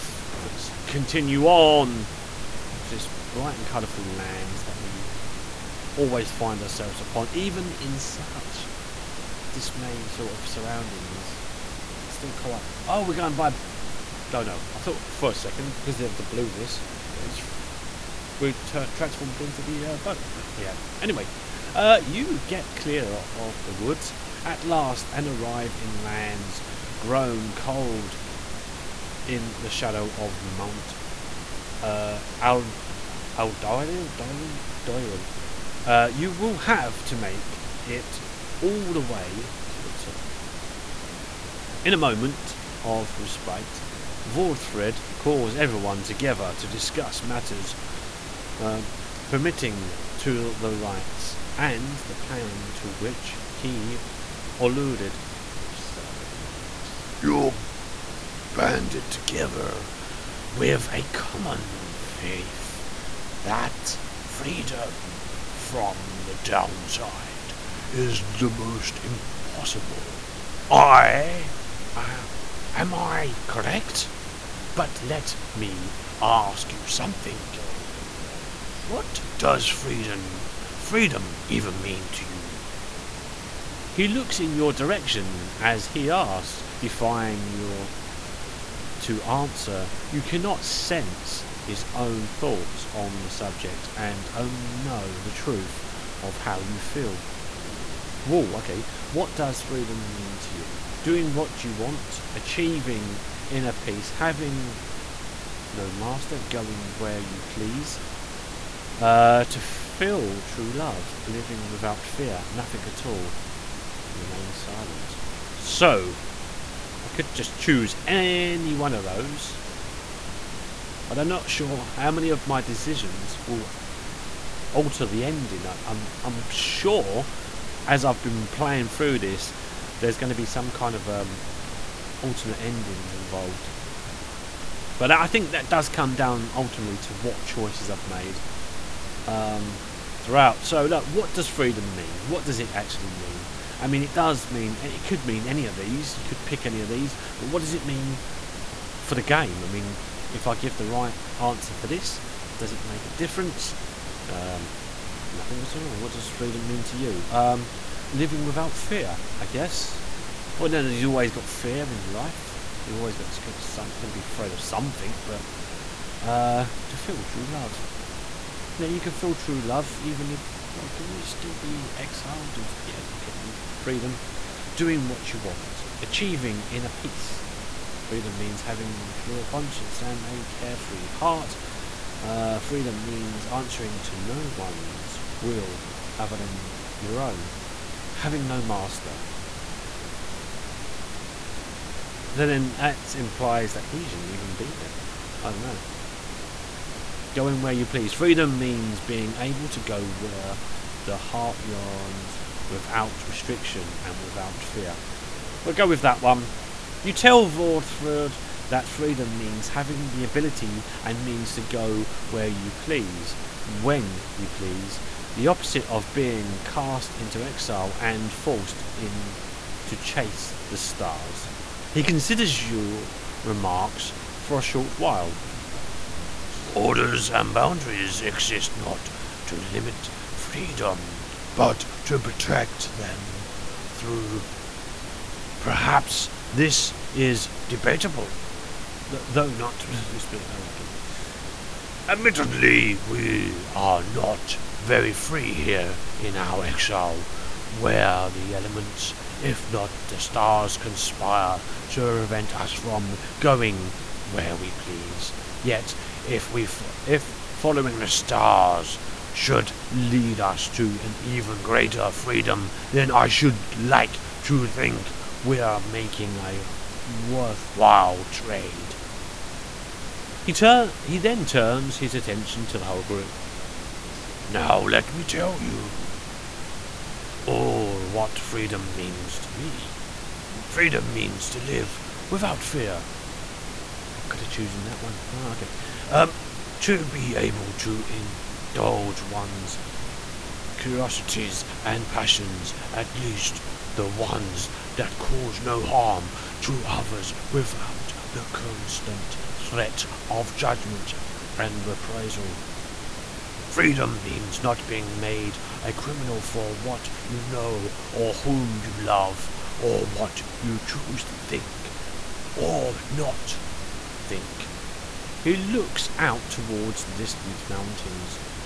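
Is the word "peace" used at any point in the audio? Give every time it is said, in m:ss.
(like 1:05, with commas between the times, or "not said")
1:43, 2:56.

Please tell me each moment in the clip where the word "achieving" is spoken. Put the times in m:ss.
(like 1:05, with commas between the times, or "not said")
1:42, 2:56.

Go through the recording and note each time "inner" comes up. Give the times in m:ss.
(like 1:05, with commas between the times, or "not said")
1:43, 2:56.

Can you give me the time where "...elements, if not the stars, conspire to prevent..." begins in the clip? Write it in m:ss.
4:08.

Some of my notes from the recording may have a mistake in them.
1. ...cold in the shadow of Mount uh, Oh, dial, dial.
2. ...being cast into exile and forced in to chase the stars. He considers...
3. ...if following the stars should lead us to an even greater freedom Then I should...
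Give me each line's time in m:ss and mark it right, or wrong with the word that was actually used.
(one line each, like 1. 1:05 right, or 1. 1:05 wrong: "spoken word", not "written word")
1. 0:27 right
2. 3:36 right
3. 4:17 right.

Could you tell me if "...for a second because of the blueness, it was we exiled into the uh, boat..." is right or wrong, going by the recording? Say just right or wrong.
wrong.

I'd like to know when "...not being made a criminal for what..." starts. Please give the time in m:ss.
5:04.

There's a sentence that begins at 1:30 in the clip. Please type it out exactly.
You cannot sense his own thoughts on the subject and only know the truth of how you feel.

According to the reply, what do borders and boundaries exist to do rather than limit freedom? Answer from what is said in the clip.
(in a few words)
Protect them.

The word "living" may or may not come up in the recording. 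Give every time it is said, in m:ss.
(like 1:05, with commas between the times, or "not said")
1:51, 2:38.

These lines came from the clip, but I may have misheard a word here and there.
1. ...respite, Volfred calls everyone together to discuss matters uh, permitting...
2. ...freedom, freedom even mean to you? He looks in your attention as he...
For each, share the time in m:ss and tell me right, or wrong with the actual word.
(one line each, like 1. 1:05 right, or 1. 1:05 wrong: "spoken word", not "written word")
1. 0:43 right
2. 1:19 wrong: "direction", not "attention".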